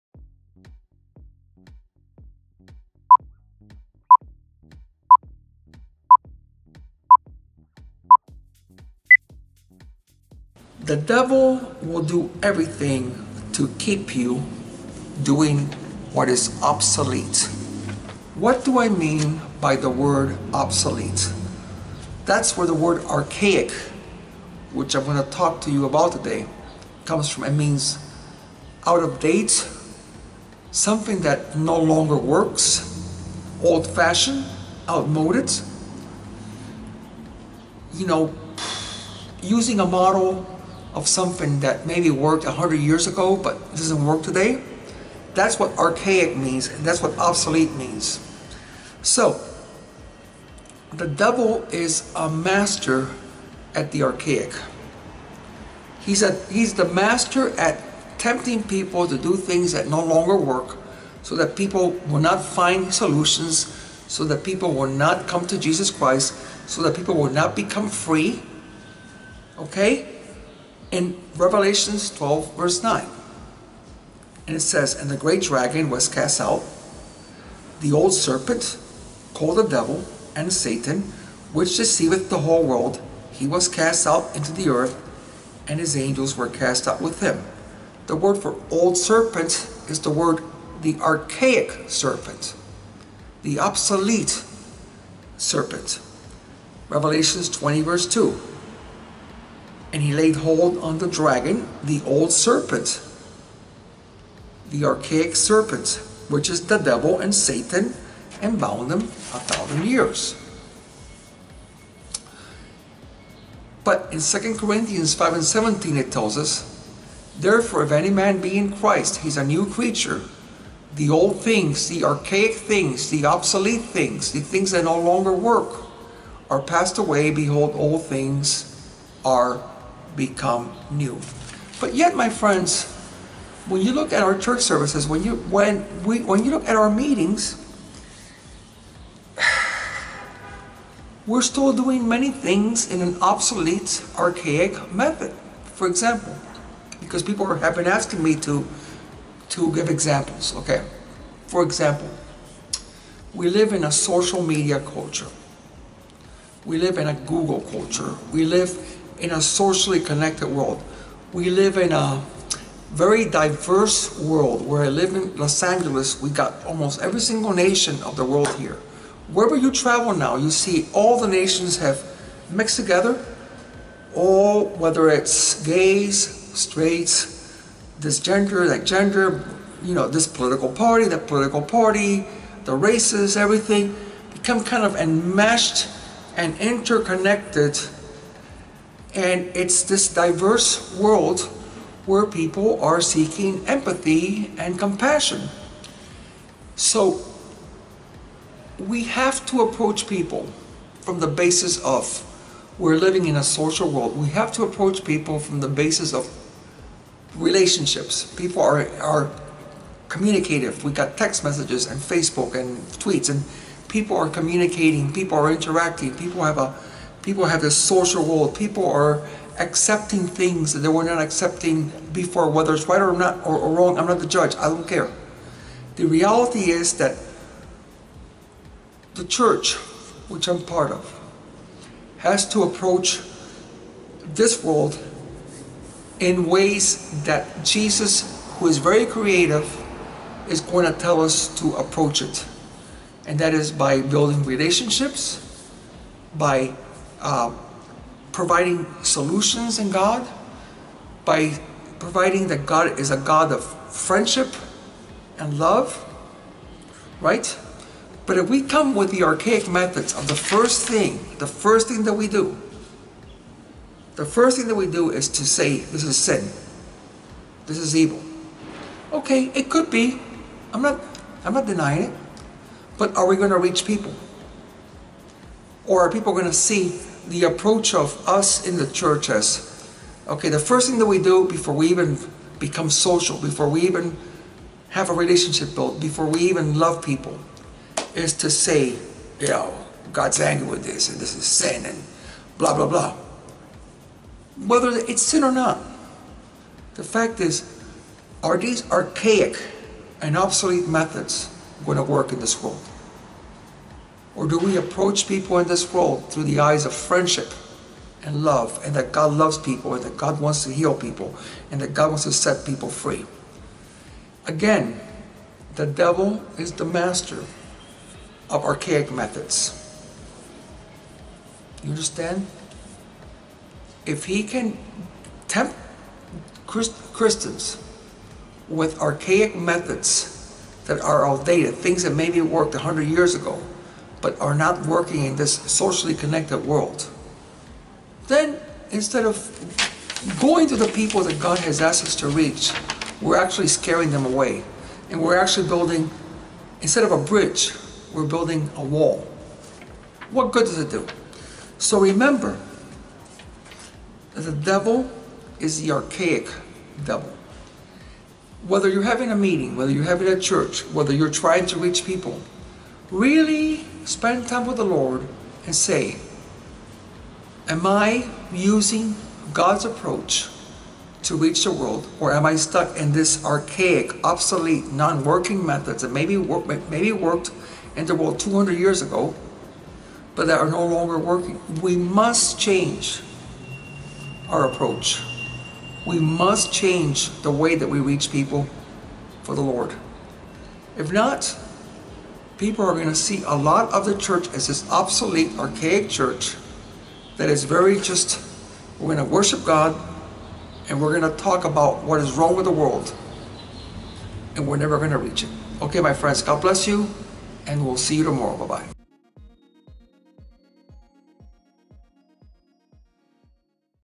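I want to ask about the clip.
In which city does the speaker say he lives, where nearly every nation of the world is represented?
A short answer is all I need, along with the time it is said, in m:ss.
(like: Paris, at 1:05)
Los Angeles, at 2:45.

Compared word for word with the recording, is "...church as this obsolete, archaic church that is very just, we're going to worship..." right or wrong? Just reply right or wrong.
right.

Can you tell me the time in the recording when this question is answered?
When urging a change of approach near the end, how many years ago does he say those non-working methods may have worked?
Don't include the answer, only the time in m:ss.
6:18.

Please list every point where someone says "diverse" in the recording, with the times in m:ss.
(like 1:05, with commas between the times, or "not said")
2:43, 3:10.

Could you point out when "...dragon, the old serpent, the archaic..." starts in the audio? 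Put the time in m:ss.
1:41.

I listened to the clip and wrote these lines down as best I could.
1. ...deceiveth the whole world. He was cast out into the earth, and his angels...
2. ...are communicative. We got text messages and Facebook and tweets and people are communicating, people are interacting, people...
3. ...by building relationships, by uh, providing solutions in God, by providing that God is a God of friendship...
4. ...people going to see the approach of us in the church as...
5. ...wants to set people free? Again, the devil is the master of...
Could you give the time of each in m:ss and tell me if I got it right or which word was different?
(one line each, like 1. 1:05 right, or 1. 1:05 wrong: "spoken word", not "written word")
1. 1:21 right
2. 3:28 right
3. 4:03 right
4. 4:36 right
5. 5:12 right.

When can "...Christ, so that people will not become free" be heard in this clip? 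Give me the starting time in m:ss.
1:05.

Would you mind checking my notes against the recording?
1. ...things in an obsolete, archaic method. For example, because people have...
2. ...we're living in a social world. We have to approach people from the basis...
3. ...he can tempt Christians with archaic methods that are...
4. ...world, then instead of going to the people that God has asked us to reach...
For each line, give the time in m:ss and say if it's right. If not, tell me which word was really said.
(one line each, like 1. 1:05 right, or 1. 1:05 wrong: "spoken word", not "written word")
1. 2:22 right
2. 3:22 right
3. 5:24 right
4. 5:36 right.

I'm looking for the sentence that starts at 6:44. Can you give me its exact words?
And we're never going to reach it.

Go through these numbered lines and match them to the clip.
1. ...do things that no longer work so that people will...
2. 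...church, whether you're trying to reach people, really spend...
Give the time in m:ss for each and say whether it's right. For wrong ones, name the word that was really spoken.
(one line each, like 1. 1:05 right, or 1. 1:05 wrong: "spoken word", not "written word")
1. 0:59 right
2. 6:00 right.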